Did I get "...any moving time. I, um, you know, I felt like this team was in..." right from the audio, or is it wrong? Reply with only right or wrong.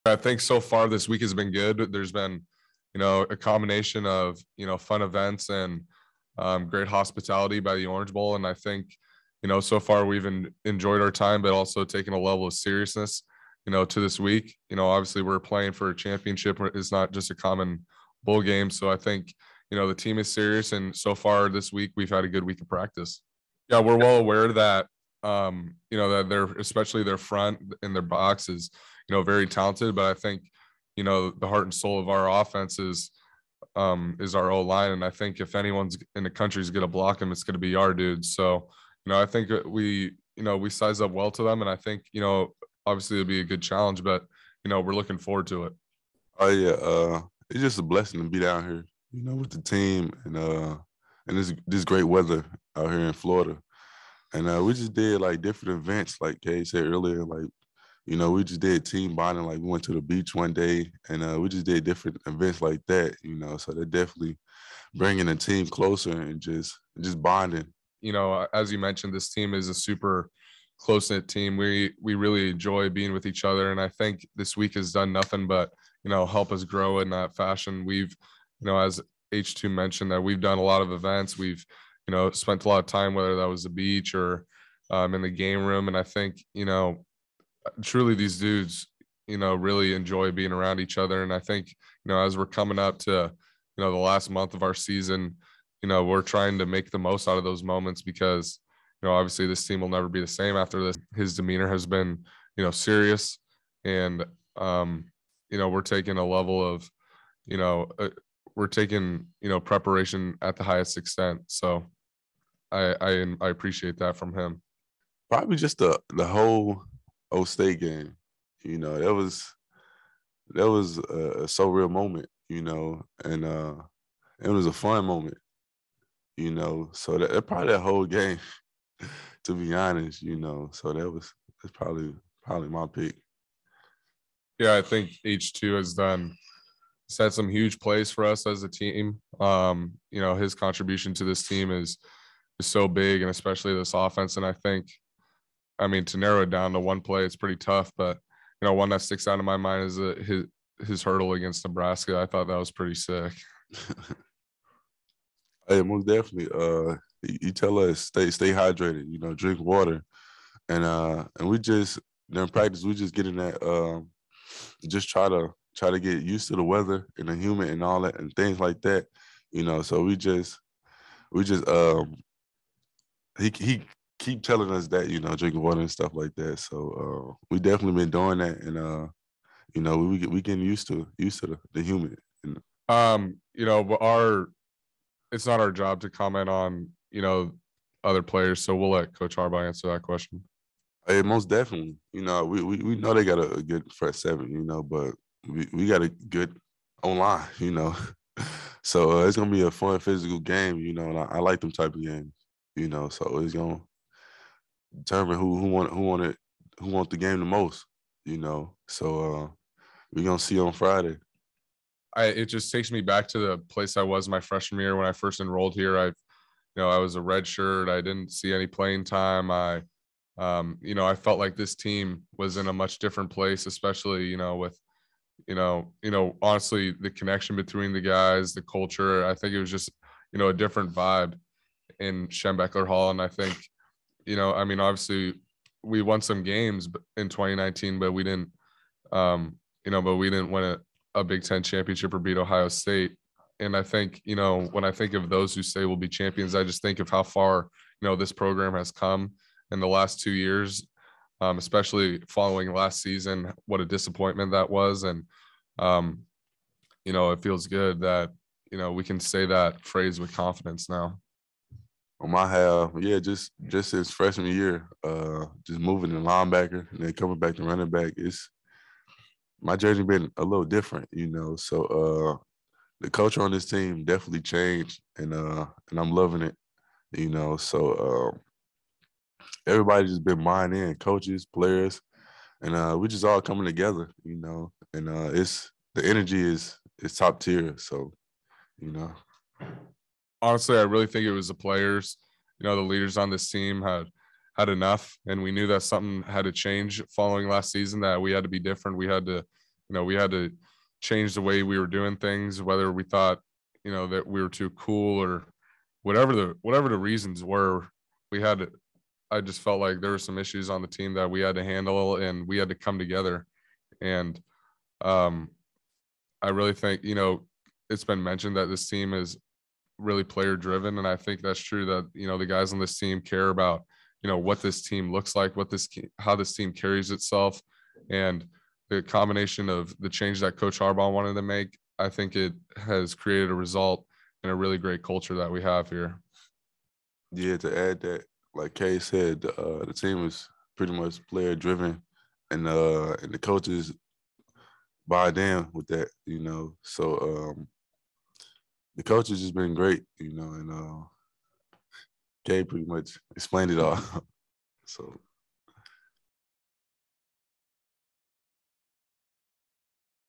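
wrong.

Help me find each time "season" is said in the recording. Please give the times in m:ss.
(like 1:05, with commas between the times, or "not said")
1:34, 4:13, 4:57.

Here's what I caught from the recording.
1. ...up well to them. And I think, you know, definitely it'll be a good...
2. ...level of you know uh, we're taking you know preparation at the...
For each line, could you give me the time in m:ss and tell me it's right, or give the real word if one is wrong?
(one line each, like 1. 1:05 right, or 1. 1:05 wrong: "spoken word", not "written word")
1. 0:41 wrong: "obviously", not "definitely"
2. 1:46 right.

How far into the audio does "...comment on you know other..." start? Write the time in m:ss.
3:06.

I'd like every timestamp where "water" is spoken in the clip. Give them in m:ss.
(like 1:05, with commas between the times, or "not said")
2:39, 2:55.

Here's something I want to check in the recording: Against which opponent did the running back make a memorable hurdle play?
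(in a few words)
Nebraska.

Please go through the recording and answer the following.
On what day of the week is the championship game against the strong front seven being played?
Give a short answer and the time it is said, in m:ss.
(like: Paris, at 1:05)
Friday, at 3:30.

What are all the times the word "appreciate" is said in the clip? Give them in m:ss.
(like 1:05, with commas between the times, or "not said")
1:53.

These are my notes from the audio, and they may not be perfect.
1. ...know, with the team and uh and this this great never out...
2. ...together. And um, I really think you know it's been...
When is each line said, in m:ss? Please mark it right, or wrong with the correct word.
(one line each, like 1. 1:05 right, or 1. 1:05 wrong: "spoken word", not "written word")
1. 0:49 wrong: "weather", not "never"
2. 5:12 right.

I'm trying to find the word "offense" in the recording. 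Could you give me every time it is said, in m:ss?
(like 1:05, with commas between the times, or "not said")
0:32, 2:23.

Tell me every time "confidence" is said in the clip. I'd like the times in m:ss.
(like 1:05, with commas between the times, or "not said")
4:20.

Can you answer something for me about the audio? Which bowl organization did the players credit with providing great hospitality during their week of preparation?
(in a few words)
Orange Bowl.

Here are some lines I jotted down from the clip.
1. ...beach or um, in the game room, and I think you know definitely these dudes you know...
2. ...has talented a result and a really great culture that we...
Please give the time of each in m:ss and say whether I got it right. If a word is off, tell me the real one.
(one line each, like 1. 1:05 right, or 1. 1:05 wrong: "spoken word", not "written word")
1. 1:23 wrong: "truly", not "definitely"
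2. 5:32 wrong: "created", not "talented".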